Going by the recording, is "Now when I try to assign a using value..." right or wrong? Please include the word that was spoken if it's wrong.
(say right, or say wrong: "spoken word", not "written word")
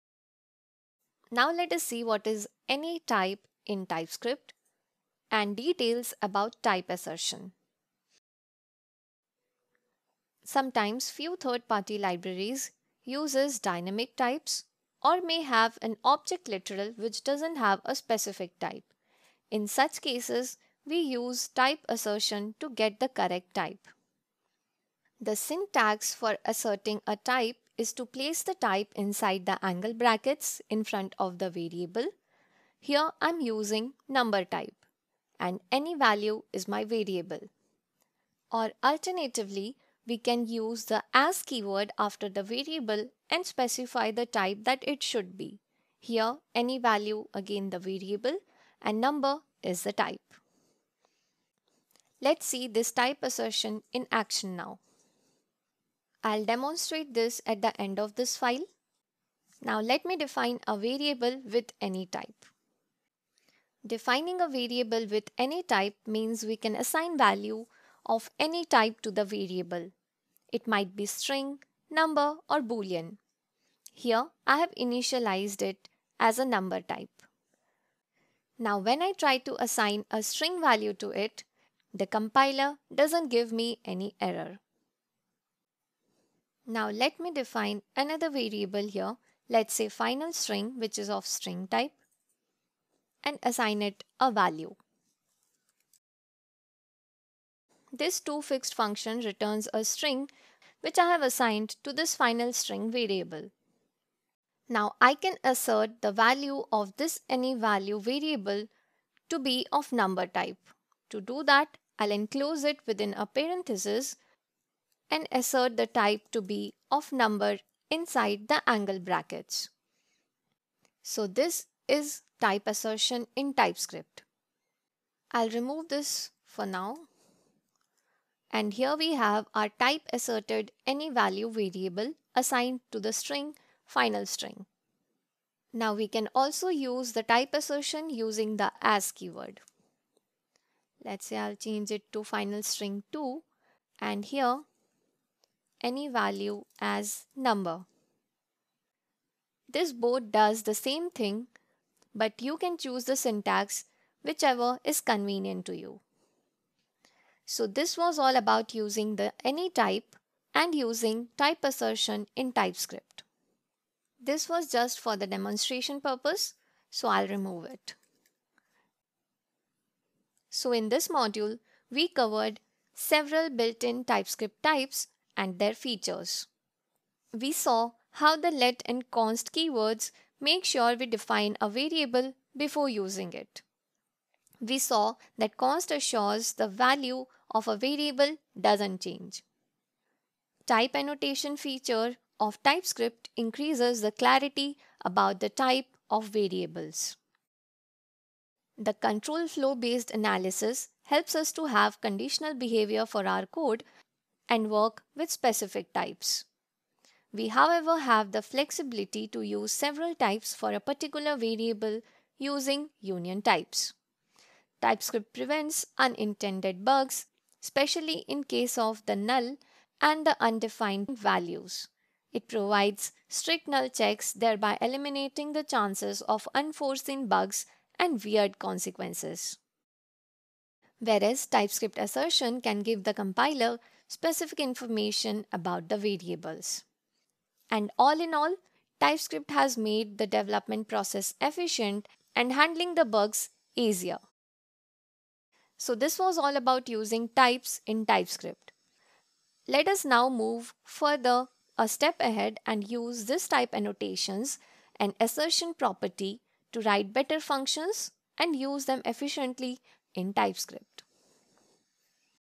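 wrong: "string", not "using".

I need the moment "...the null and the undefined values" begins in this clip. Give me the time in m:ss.
3:39.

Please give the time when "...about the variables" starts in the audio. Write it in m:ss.
3:55.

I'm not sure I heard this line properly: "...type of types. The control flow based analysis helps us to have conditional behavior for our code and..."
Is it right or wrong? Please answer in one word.
wrong.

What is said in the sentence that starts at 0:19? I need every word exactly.
In such cases, we use type assertion to get the correct type.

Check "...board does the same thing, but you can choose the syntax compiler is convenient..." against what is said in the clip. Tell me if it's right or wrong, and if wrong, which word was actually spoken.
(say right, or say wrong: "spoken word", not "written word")
wrong: "whichever", not "compiler".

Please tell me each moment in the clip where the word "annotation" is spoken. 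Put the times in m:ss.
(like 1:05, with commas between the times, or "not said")
3:10, 4:13.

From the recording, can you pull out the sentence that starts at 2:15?
Now we can also use the type assertion using the as keyword.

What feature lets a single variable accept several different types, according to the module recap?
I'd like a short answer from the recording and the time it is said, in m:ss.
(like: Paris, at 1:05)
union types, at 3:32.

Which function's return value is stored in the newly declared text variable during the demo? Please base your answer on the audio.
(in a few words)
toFixed.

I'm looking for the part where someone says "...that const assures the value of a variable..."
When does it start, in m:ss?
3:05.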